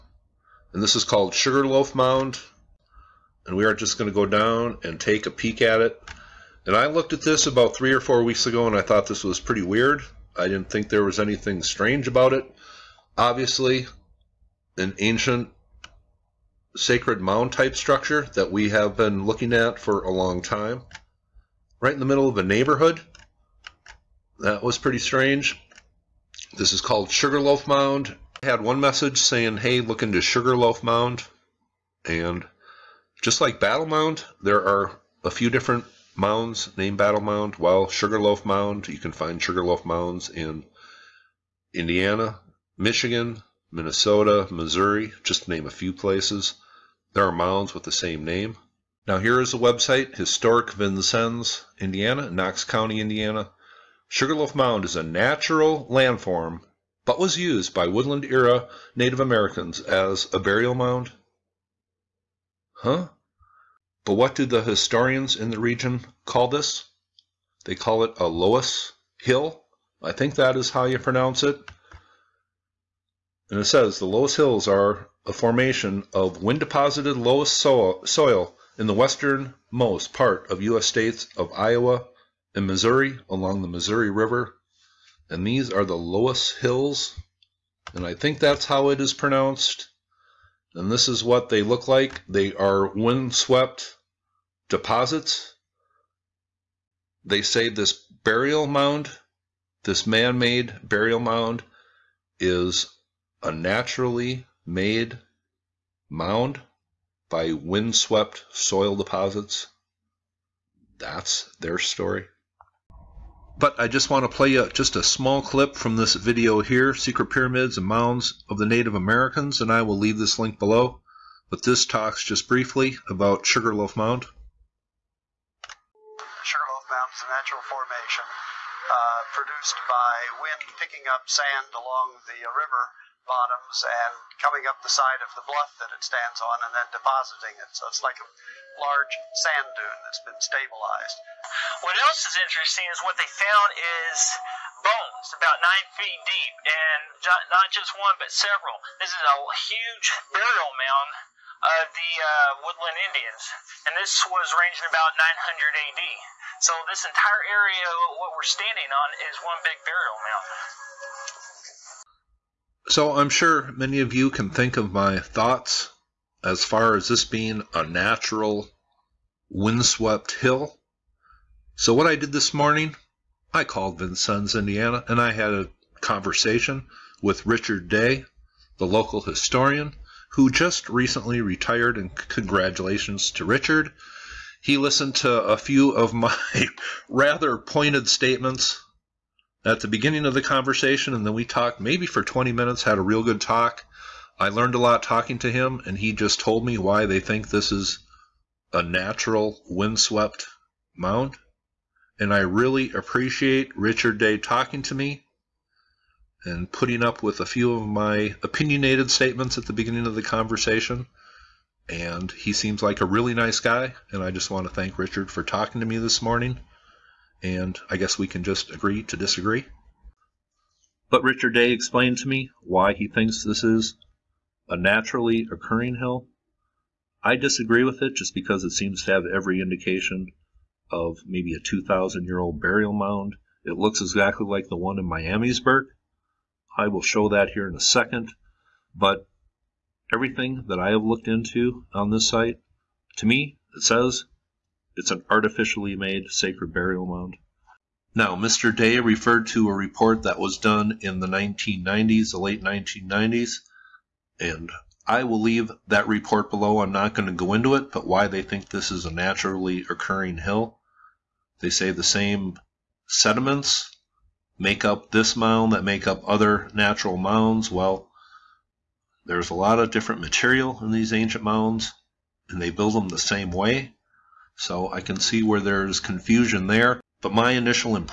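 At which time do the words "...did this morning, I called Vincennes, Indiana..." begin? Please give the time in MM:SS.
02:52.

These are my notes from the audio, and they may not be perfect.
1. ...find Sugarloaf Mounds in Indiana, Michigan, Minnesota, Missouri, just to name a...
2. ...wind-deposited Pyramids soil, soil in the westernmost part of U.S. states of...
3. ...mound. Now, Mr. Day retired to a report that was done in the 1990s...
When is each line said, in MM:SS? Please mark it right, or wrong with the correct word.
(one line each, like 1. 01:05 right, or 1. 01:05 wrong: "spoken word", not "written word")
1. 00:39 right
2. 01:16 wrong: "Loess", not "Pyramids"
3. 04:07 wrong: "referred", not "retired".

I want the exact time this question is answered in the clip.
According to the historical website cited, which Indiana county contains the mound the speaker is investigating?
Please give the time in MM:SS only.
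00:52.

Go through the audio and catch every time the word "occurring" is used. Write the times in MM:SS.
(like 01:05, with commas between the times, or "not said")
03:45, 04:19.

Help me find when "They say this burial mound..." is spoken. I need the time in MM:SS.
01:37.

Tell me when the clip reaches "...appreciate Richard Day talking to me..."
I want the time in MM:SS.
03:22.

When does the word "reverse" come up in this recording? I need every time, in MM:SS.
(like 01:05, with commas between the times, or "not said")
not said.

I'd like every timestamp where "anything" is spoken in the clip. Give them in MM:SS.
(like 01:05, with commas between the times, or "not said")
00:11.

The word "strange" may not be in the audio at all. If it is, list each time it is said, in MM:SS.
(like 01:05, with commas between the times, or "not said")
00:11, 00:24.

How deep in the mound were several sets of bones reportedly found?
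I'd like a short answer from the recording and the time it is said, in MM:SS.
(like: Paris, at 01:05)
9 feet, at 02:25.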